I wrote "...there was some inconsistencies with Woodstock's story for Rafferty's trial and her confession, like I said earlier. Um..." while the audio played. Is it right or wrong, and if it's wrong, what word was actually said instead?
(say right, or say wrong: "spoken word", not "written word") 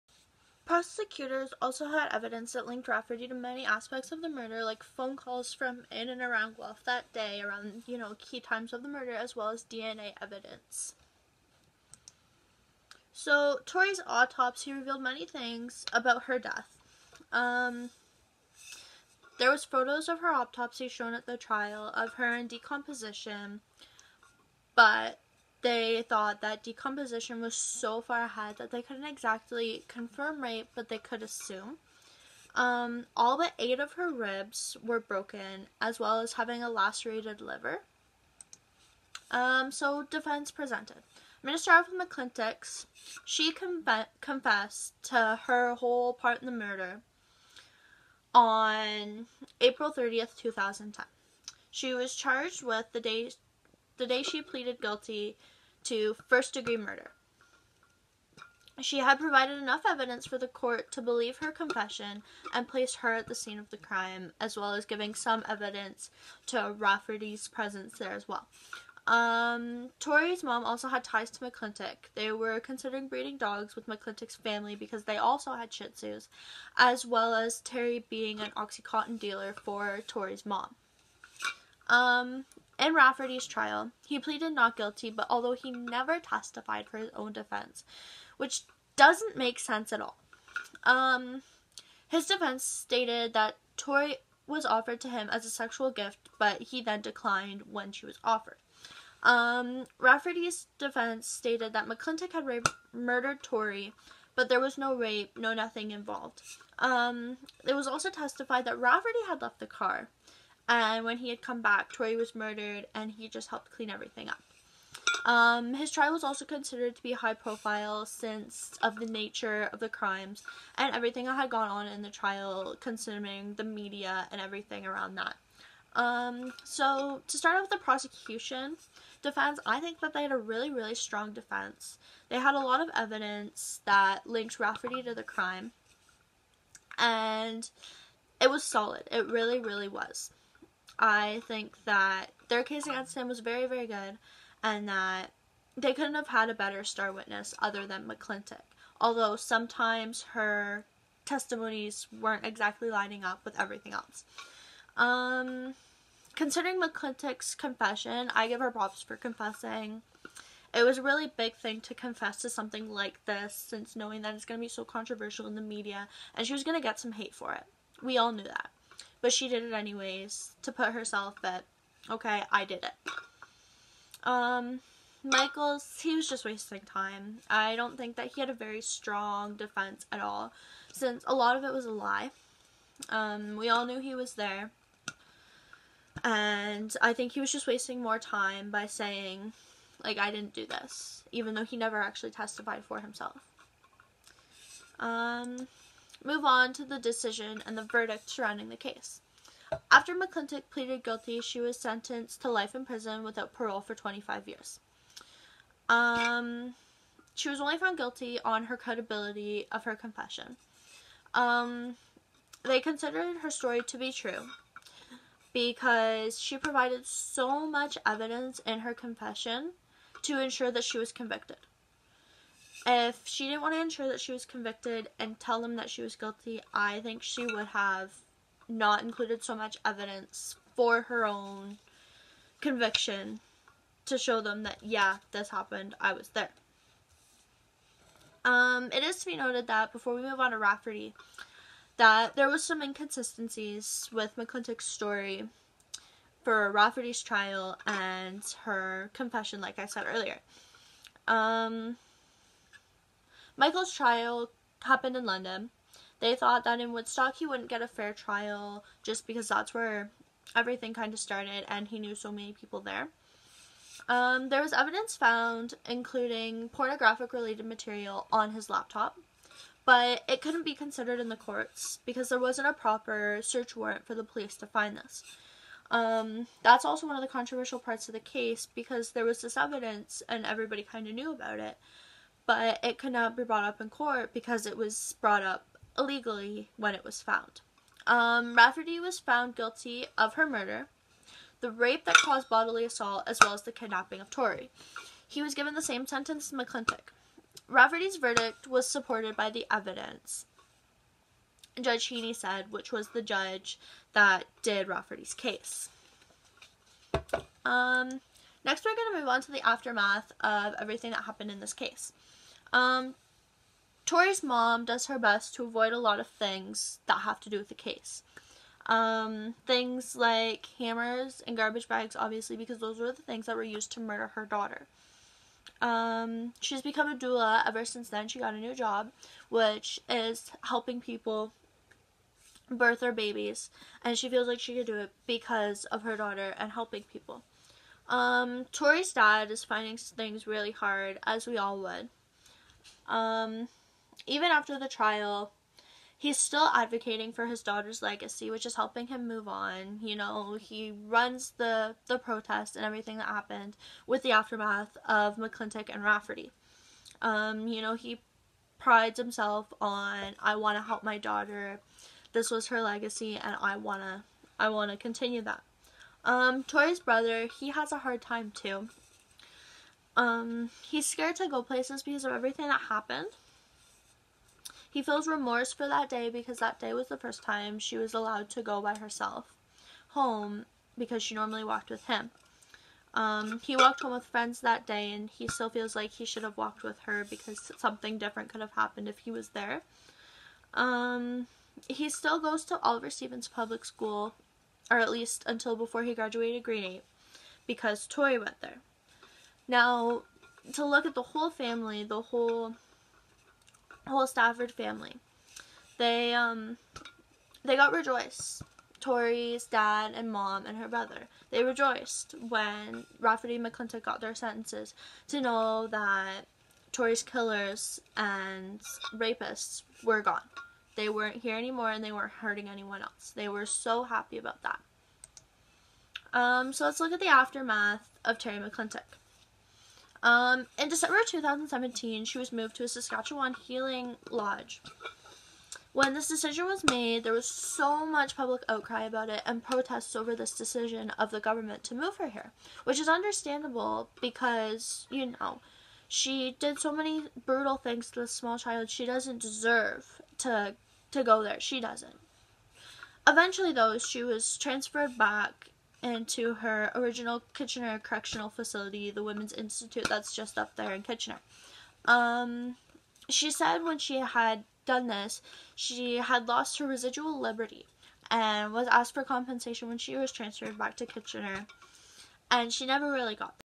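wrong: "McClintock", not "Woodstock".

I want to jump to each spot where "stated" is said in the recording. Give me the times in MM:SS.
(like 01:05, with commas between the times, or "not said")
01:32, 01:41.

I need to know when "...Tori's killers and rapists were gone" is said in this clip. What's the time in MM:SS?
06:56.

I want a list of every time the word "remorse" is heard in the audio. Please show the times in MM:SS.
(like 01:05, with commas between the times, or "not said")
06:15.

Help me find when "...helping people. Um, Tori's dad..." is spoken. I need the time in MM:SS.
05:36.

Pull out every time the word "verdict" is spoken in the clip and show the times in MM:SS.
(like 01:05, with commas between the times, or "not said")
03:17, 04:58.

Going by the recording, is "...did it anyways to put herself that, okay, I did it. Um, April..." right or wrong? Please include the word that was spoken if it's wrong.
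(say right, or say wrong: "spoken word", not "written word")
wrong: "Michaels", not "April".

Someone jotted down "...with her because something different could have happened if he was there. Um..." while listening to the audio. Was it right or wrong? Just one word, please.
right.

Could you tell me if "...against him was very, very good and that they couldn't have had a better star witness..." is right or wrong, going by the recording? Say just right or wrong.
right.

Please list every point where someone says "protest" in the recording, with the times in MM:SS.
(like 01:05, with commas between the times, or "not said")
05:52, 07:19.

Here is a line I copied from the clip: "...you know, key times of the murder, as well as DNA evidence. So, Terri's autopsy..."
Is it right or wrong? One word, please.
wrong.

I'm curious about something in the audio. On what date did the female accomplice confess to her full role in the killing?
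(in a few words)
April 30th, 2010.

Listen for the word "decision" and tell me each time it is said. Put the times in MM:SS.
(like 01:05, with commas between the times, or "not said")
03:16, 07:16, 07:20.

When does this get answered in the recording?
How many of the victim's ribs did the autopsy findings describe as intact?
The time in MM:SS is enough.
00:33.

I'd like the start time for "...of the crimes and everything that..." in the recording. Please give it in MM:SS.
01:59.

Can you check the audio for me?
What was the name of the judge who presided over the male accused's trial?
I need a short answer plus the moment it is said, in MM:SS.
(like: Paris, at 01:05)
Judge Heeney, at 05:01.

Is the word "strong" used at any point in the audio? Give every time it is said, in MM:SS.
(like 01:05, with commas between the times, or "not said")
02:10, 02:58.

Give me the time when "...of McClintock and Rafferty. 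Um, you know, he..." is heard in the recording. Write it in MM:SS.
05:55.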